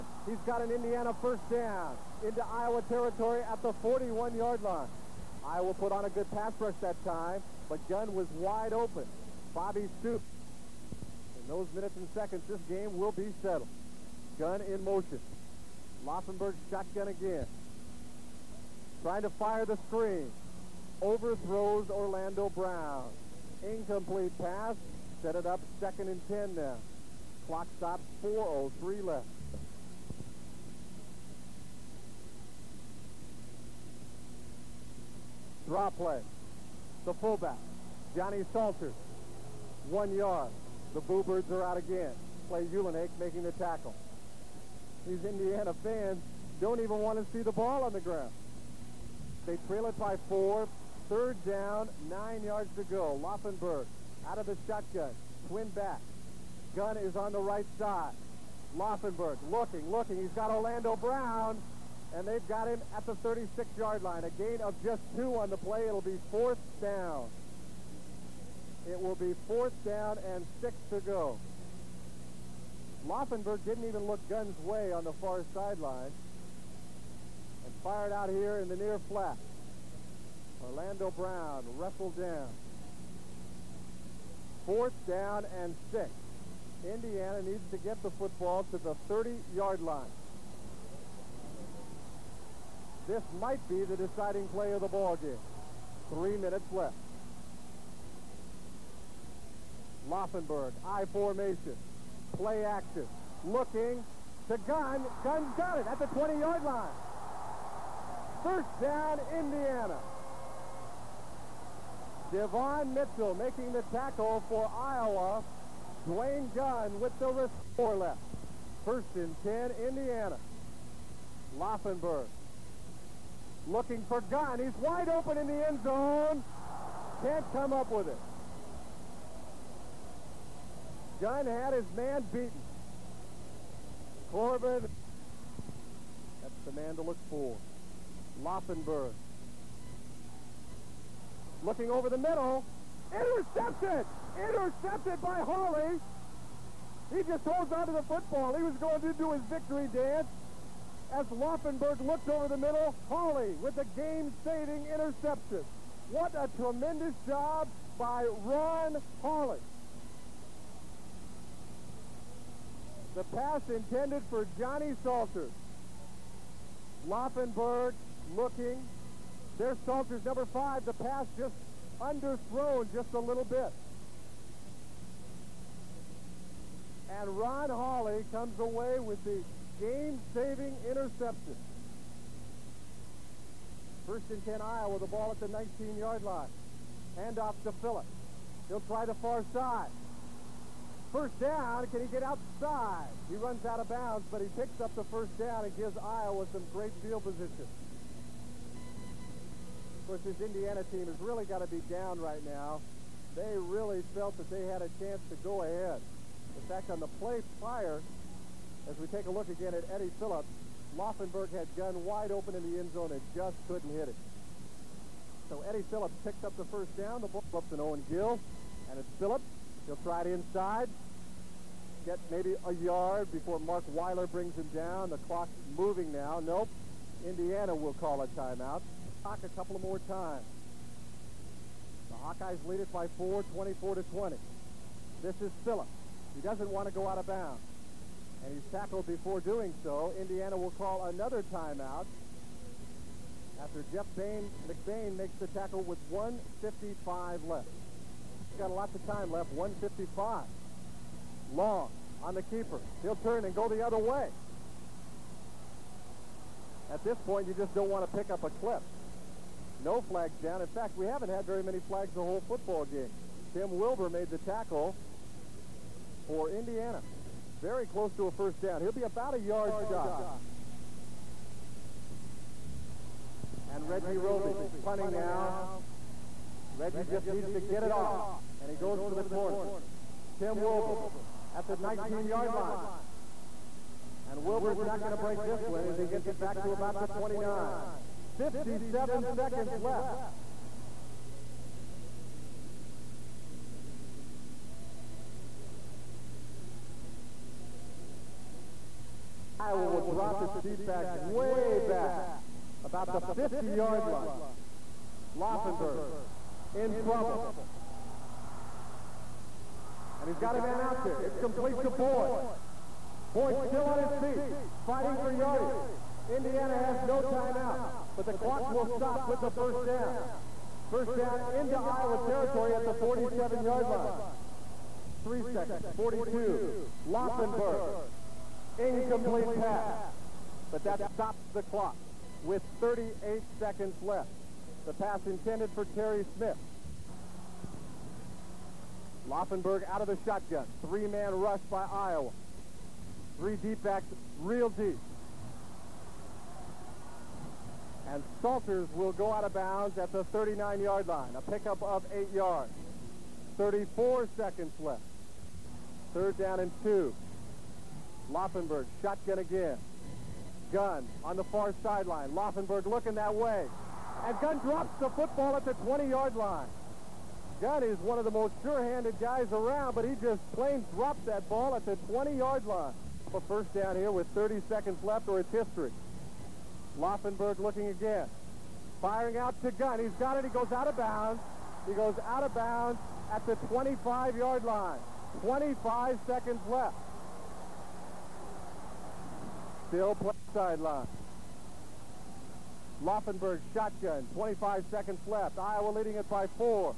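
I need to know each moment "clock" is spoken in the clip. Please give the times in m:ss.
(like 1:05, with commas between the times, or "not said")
0:27, 3:45, 3:49, 5:18, 5:31.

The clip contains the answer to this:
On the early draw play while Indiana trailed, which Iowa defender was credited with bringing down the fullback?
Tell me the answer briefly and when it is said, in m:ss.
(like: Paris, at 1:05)
Clay Uhlenhake, at 0:42.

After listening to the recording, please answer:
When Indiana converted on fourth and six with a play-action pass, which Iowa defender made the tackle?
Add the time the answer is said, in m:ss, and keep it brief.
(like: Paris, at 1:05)
Devon Mitchell, at 1:52.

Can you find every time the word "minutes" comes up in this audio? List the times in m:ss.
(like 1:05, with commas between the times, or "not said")
0:11, 1:36.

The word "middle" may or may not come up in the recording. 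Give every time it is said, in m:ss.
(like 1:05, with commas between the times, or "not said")
2:22, 2:32.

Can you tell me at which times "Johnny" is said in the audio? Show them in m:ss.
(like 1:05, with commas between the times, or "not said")
0:38, 2:44.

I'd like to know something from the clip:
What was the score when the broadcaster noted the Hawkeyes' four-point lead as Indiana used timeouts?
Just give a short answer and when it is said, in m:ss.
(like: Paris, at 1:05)
24 to 20, at 3:53.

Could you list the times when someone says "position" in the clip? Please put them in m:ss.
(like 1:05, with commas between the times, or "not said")
3:17.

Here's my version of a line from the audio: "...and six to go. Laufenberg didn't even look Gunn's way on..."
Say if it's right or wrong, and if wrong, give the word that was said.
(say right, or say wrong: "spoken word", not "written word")
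right.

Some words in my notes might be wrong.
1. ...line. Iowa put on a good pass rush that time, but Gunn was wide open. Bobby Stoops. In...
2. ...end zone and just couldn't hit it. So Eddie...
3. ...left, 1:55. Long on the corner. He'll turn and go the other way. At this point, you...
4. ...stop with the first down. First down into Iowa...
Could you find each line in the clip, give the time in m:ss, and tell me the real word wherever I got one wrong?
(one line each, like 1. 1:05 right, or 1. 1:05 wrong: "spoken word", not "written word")
1. 0:04 right
2. 3:32 right
3. 4:09 wrong: "keeper", not "corner"
4. 5:18 right.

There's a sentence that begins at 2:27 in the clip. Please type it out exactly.
He just holds onto the football.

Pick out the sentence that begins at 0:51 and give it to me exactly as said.
Third down, nine yards to go.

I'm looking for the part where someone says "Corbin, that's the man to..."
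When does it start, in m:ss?
2:14.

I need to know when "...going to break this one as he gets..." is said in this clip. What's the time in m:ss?
4:45.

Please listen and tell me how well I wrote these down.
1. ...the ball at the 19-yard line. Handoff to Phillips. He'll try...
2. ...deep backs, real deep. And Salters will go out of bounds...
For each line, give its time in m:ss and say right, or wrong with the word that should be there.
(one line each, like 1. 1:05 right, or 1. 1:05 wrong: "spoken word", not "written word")
1. 3:04 right
2. 5:43 right.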